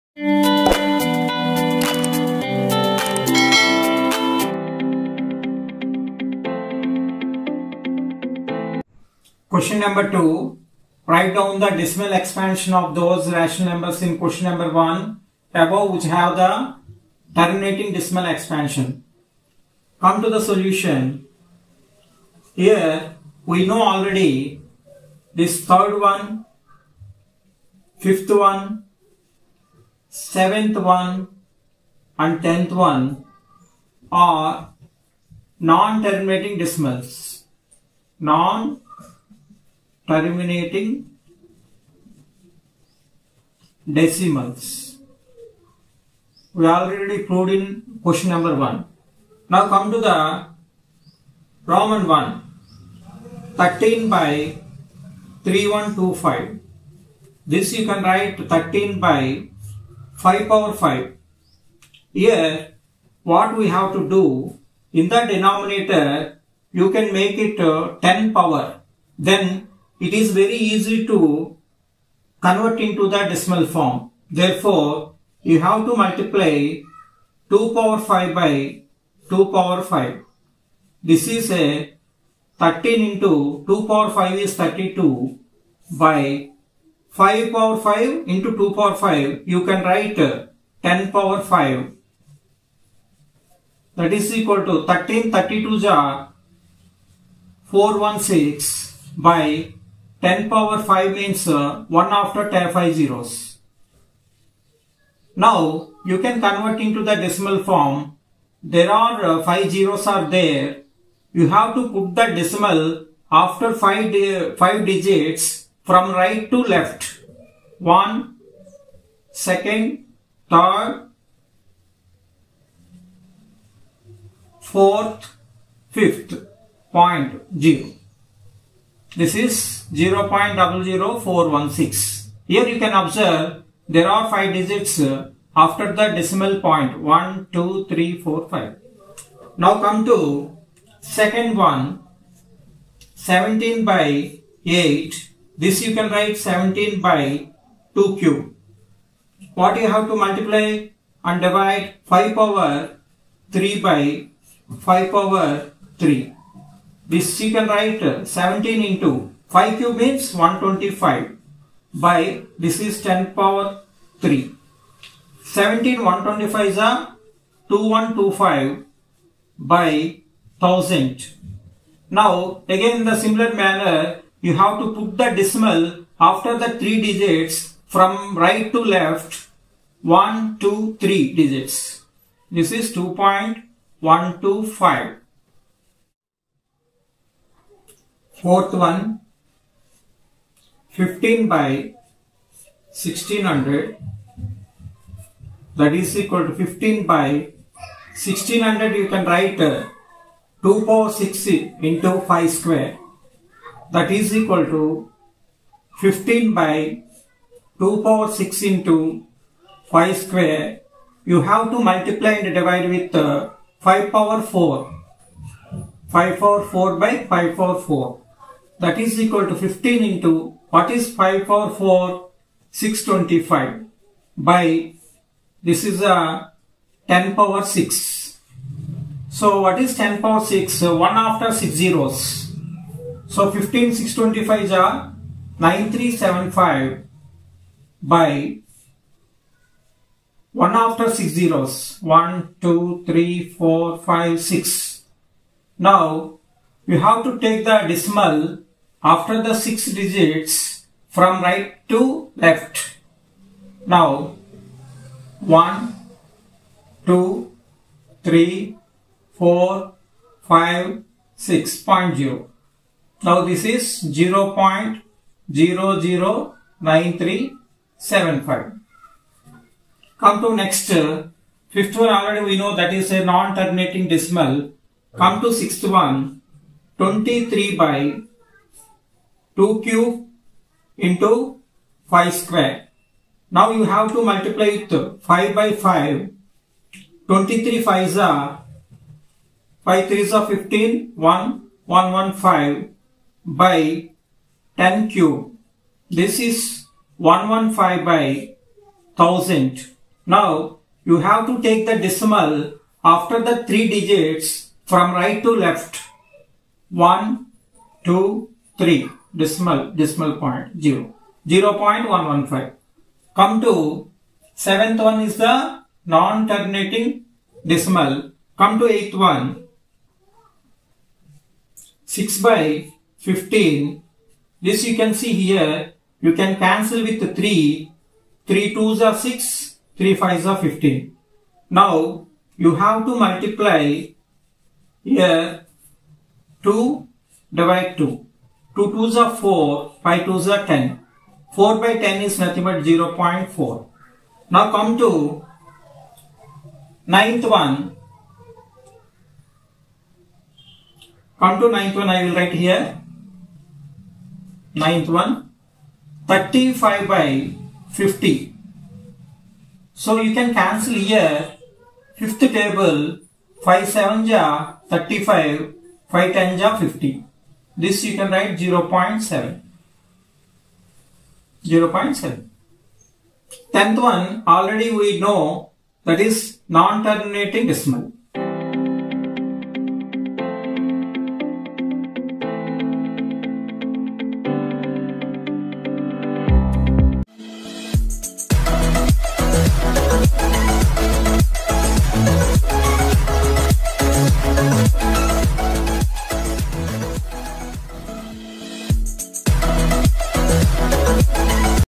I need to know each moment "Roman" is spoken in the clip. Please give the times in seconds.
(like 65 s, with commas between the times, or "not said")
51 s.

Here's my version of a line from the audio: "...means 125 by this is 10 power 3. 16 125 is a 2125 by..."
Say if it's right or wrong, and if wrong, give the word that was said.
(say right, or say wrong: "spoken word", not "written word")
wrong: "17", not "16".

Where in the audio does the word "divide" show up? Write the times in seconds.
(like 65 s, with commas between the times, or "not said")
151 s, 212 s, 337 s.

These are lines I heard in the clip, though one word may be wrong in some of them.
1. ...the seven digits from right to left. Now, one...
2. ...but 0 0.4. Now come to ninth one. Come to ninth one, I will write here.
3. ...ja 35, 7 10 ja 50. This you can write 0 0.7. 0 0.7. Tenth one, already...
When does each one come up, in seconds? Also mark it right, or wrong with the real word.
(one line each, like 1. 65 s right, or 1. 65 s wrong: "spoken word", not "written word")
1. 249 s wrong: "six", not "seven"
2. 342 s right
3. 364 s wrong: "5", not "7".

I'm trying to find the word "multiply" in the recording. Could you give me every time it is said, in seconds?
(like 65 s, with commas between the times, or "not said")
75 s, 150 s, 211 s, 284 s, 333 s.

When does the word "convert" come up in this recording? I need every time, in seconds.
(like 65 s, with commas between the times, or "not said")
72 s, 106 s.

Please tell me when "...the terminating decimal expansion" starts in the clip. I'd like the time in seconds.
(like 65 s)
16 s.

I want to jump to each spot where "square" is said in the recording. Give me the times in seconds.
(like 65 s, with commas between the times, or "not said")
202 s, 210 s, 282 s.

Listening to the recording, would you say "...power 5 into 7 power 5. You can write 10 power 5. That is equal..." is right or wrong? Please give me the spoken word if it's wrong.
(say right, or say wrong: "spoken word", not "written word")
wrong: "2", not "7".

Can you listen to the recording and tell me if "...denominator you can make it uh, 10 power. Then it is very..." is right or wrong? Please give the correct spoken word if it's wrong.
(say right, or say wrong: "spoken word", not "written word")
right.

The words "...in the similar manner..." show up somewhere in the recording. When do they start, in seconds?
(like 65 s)
173 s.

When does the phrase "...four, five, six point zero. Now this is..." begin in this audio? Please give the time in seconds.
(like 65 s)
259 s.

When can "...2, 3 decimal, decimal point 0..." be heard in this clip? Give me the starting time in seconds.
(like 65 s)
308 s.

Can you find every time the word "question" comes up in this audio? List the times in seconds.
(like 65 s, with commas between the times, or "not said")
9 s, 14 s, 48 s.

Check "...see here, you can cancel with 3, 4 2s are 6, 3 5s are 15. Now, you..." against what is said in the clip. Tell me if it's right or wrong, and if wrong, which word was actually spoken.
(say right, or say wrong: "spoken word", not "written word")
wrong: "3", not "4".